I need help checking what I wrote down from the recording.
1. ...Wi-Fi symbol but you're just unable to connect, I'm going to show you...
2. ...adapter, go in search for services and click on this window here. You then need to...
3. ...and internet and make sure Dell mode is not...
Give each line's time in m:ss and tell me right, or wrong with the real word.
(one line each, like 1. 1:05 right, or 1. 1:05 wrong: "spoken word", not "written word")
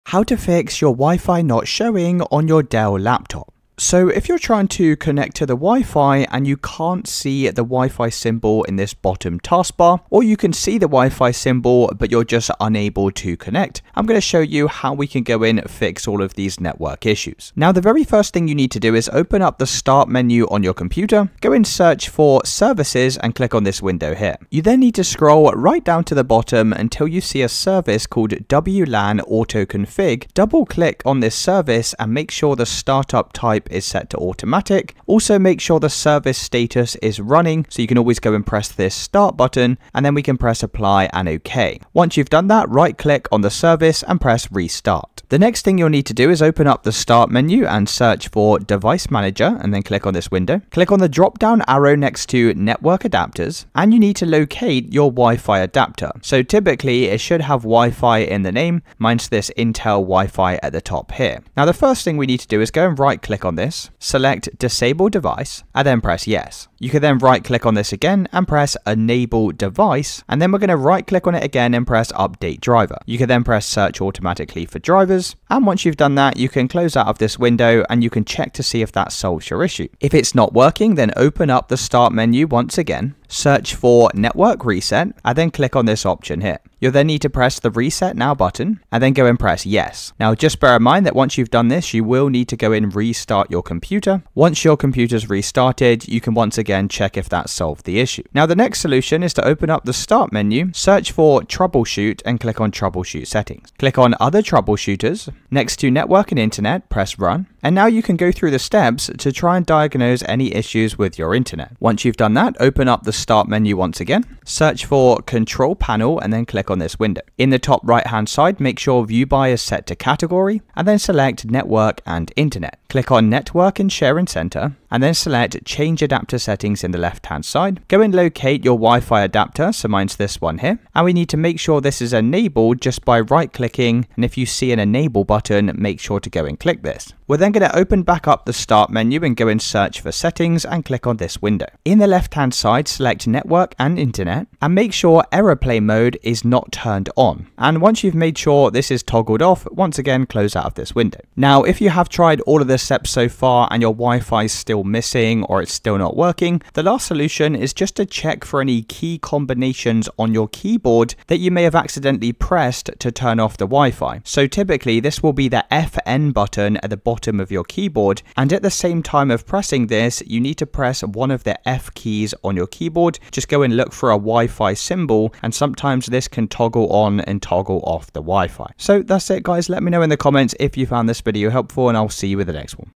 1. 0:10 right
2. 0:20 wrong: "computer", not "adapter"
3. 2:23 wrong: "Airplane", not "Dell".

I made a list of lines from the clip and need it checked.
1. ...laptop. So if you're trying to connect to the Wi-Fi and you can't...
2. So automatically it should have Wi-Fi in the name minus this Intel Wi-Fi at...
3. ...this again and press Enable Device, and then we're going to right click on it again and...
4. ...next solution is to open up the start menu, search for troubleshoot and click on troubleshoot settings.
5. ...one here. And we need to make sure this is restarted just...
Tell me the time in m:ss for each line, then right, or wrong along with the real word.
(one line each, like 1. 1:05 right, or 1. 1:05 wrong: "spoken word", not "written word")
1. 0:02 right
2. 0:56 wrong: "typically", not "automatically"
3. 1:07 right
4. 1:38 right
5. 2:10 wrong: "enabled", not "restarted".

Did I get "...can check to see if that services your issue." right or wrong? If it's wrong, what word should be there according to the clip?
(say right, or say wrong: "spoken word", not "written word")
wrong: "solves", not "services".